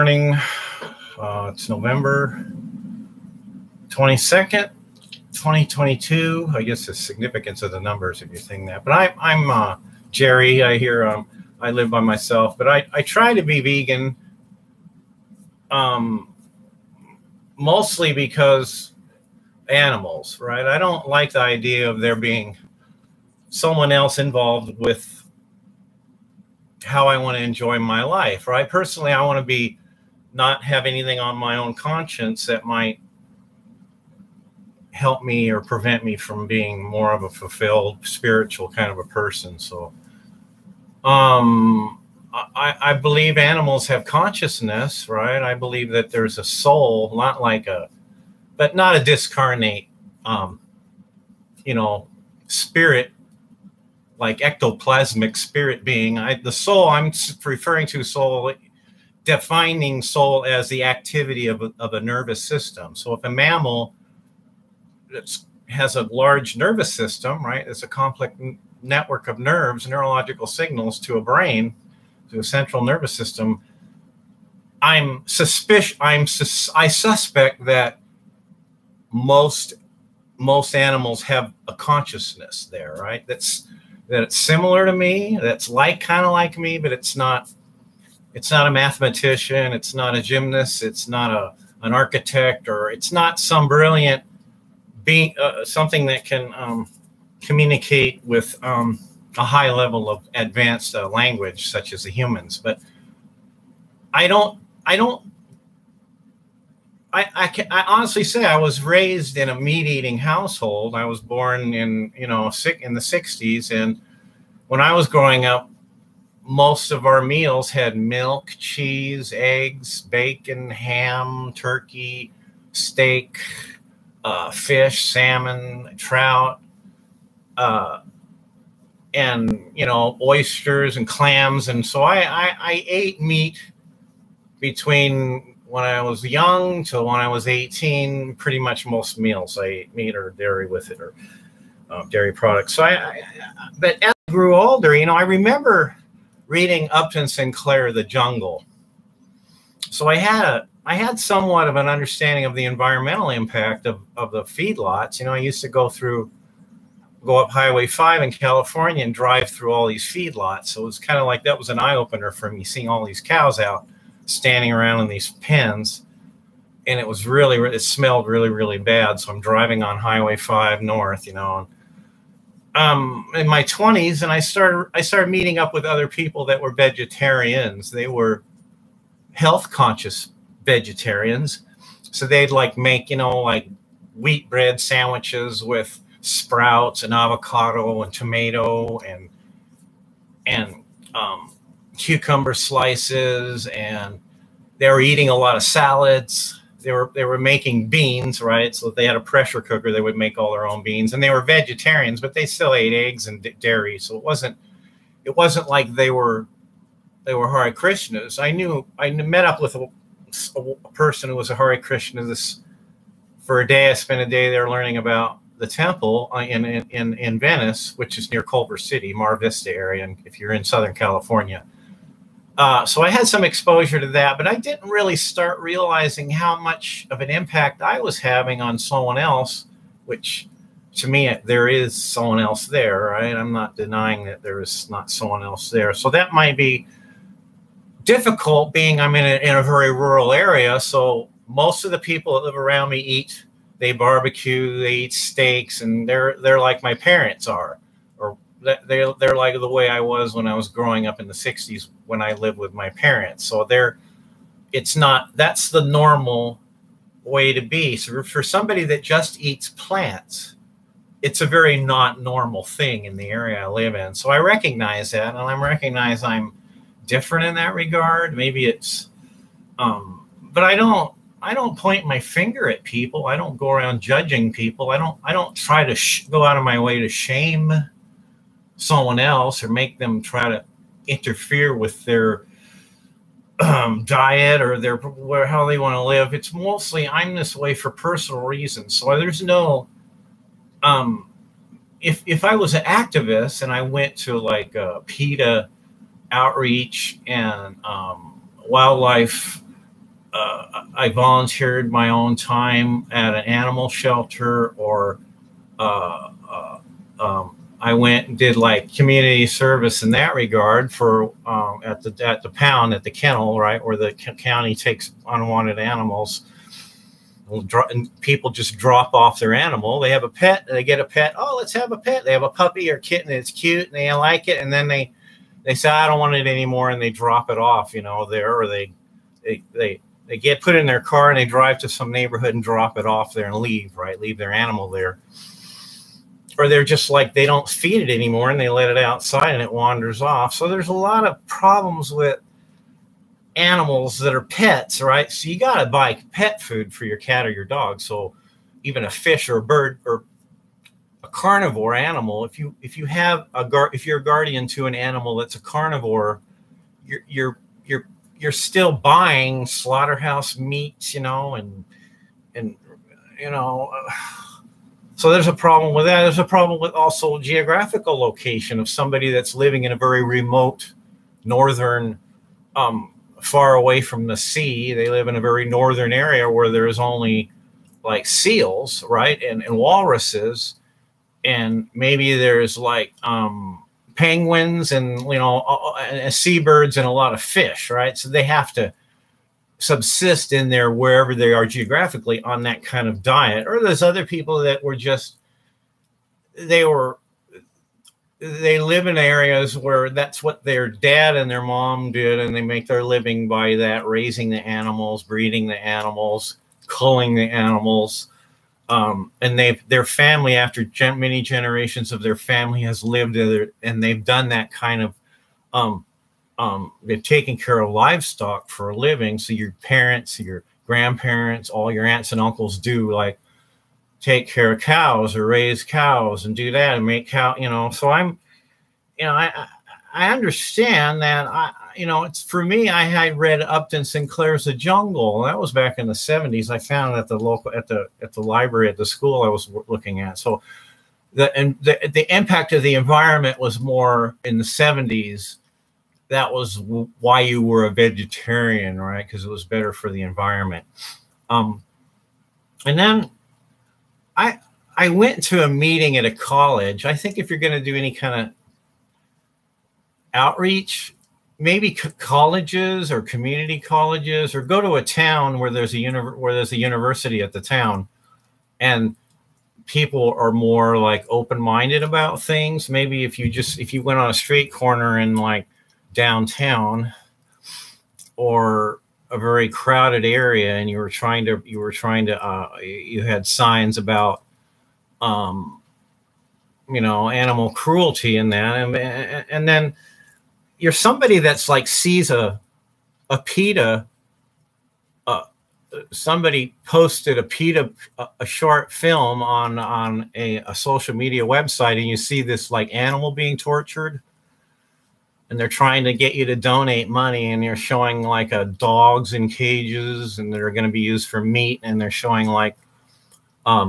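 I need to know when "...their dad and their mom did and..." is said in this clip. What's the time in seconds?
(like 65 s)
400 s.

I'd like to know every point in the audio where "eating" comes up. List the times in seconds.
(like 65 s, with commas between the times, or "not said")
109 s, 195 s.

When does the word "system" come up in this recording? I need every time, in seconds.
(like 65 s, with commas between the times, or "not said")
62 s, 66 s, 73 s.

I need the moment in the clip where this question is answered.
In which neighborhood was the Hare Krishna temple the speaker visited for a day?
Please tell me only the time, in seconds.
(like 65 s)
217 s.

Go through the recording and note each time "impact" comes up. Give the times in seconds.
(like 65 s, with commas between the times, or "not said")
153 s, 227 s, 442 s.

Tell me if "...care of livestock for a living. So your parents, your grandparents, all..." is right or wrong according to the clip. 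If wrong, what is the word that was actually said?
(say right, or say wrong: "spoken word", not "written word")
right.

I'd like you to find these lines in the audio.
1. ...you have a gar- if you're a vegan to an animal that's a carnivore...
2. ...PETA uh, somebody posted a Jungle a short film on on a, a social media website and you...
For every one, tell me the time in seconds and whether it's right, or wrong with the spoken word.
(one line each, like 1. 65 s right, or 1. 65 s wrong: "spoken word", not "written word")
1. 352 s wrong: "guardian", not "vegan"
2. 493 s wrong: "PETA", not "Jungle".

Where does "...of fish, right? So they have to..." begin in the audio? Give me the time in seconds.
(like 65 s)
387 s.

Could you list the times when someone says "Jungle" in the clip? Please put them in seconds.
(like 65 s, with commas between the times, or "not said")
148 s, 434 s.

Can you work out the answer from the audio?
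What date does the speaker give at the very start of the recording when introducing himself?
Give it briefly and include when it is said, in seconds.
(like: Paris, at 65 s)
November 22nd, 2022, at 1 s.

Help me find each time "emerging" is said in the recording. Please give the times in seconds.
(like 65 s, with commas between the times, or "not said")
not said.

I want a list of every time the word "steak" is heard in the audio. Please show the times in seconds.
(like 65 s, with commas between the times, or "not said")
122 s, 245 s.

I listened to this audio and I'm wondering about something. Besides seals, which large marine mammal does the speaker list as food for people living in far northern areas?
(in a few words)
walruses.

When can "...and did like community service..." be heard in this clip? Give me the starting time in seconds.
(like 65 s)
308 s.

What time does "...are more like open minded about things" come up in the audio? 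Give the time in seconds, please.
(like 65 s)
470 s.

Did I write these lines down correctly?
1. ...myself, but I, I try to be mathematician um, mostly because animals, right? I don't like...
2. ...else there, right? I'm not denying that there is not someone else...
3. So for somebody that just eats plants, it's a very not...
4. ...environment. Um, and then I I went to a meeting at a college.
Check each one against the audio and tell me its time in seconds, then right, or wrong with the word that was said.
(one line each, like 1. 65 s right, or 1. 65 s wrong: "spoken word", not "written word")
1. 12 s wrong: "vegan", not "mathematician"
2. 232 s right
3. 257 s right
4. 450 s right.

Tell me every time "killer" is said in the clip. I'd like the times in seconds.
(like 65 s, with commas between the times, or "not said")
not said.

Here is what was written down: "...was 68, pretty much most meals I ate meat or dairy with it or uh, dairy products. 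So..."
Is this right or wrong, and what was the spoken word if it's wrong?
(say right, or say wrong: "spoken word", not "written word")
wrong: "18", not "68".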